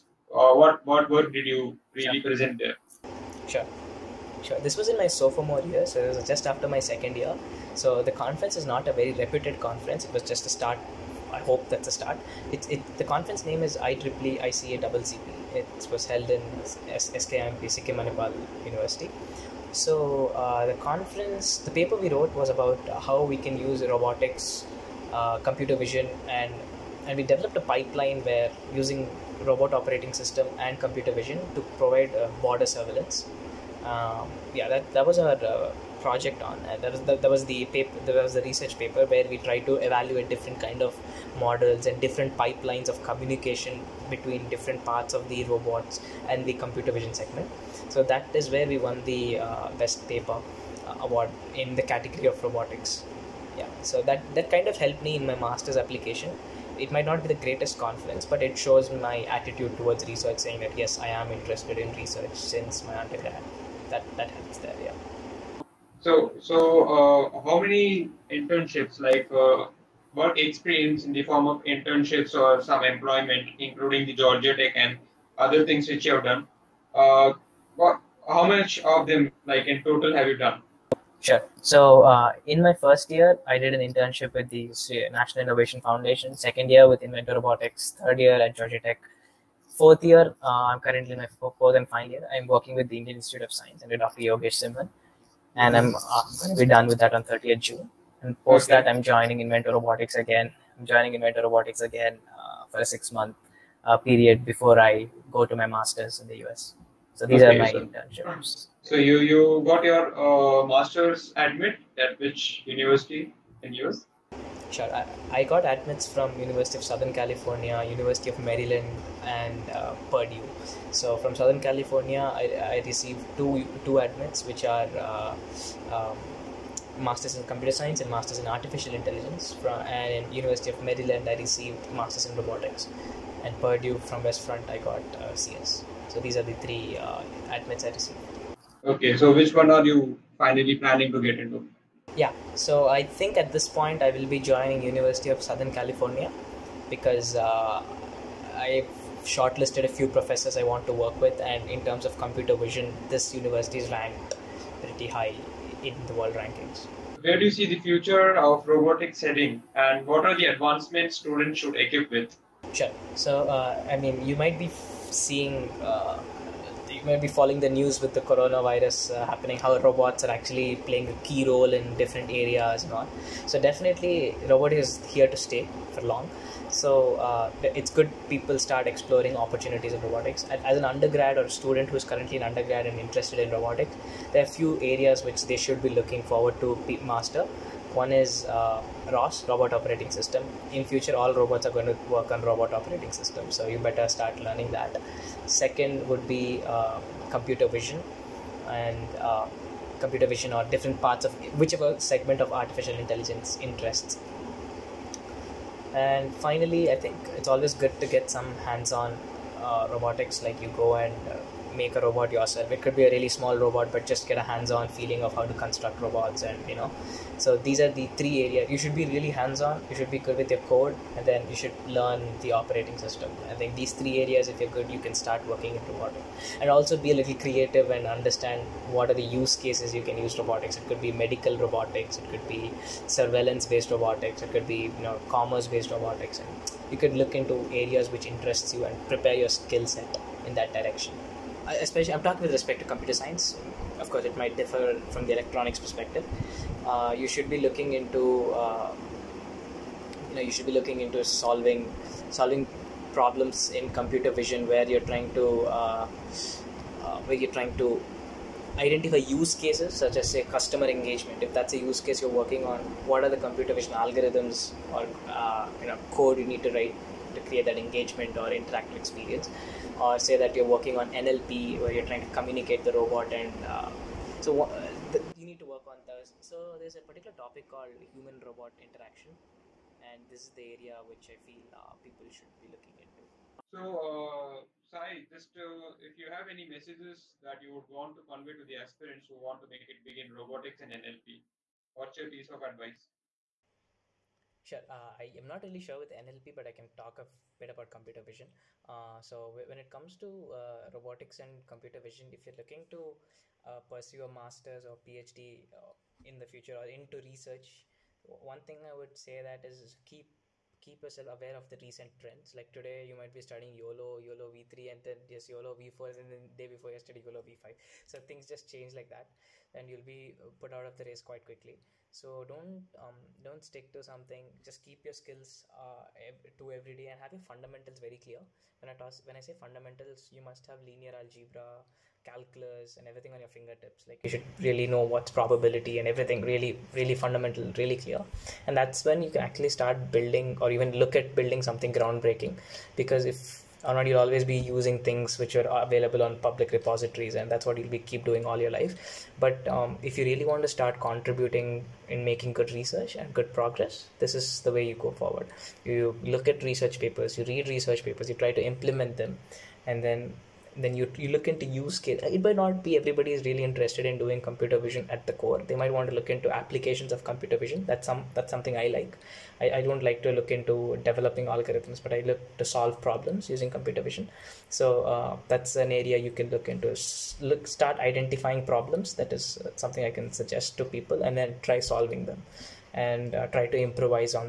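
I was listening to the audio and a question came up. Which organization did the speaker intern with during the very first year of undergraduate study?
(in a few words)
National Innovation Foundation.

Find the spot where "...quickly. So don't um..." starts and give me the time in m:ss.
5:21.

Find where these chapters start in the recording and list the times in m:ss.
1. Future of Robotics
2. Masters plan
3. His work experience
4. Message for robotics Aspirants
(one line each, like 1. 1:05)
1. 2:36
2. 1:48
3. 1:05
4. 4:43.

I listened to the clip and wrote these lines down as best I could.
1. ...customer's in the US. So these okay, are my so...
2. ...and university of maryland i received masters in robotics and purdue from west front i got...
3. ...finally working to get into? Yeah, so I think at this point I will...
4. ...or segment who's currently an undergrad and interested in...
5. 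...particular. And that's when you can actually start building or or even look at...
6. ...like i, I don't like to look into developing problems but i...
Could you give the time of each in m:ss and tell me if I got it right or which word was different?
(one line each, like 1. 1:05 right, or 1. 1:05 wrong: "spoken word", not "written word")
1. 1:45 wrong: "master", not "customer"
2. 2:10 right
3. 2:20 wrong: "planning", not "working"
4. 3:01 wrong: "student", not "segment"
5. 5:37 wrong: "clear", not "particular"
6. 6:08 wrong: "algorithms", not "problems".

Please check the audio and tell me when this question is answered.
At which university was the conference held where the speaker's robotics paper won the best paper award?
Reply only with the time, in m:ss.
0:17.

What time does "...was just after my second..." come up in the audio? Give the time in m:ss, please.
0:06.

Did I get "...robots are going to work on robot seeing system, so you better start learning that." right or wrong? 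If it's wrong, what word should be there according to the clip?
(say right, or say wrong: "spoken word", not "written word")
wrong: "operating", not "seeing".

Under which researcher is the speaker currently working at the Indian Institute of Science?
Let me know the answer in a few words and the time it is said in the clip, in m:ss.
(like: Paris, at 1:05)
Dr. Yogesh Simmhan, at 1:33.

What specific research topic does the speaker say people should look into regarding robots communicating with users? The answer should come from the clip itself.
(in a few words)
human robot interaction.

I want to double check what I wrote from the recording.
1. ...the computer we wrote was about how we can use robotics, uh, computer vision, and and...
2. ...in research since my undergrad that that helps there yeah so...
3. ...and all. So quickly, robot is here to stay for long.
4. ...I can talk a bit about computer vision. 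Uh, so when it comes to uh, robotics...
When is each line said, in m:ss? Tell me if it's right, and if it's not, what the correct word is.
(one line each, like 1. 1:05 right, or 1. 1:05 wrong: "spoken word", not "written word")
1. 0:21 wrong: "paper", not "computer"
2. 1:01 right
3. 2:52 wrong: "definitely", not "quickly"
4. 4:56 right.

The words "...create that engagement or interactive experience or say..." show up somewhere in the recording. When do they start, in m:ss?
4:27.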